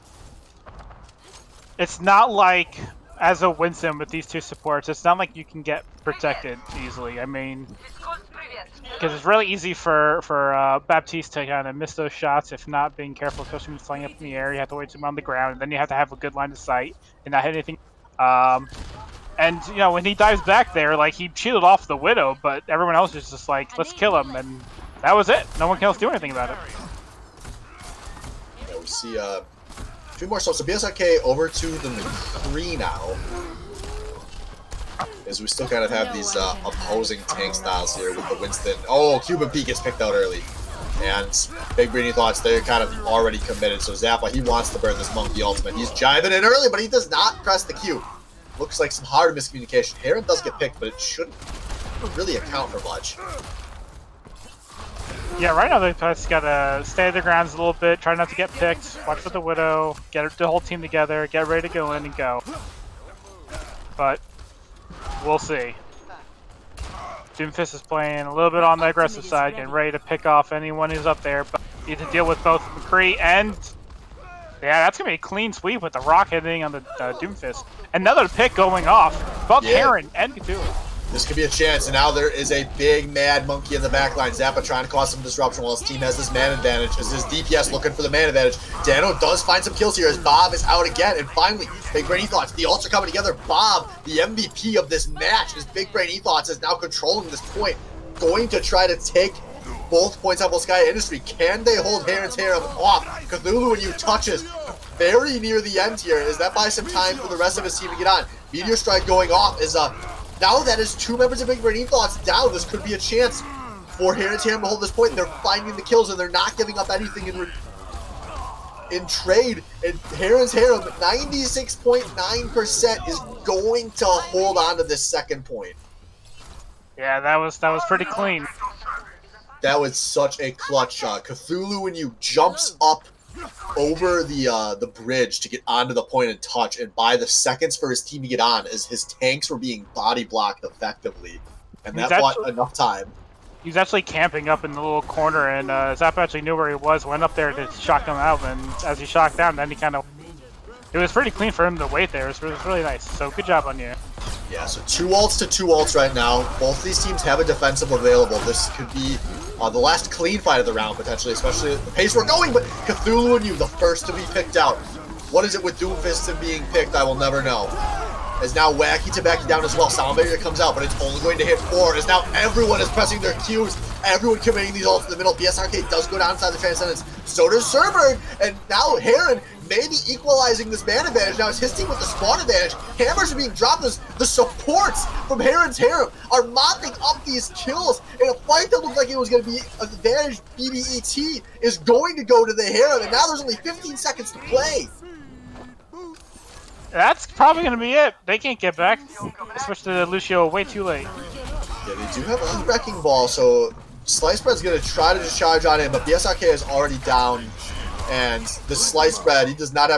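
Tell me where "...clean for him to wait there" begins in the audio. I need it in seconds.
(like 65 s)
151 s.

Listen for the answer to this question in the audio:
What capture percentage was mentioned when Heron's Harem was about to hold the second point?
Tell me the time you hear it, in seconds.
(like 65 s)
120 s.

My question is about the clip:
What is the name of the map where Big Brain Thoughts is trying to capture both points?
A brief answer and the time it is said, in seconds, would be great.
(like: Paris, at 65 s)
Sky Industry, at 100 s.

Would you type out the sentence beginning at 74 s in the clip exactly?
Yeah, that's gonna be a clean sweep with the rock hitting on the uh, Doomfist.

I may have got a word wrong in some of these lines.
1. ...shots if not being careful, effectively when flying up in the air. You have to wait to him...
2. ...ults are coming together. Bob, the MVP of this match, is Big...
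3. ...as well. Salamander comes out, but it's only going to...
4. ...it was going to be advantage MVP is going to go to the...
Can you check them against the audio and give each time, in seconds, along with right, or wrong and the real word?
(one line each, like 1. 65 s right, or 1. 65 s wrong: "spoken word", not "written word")
1. 12 s wrong: "especially", not "effectively"
2. 92 s right
3. 169 s right
4. 189 s wrong: "BBET", not "MVP".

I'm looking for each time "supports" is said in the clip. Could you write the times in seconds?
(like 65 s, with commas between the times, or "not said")
4 s, 184 s.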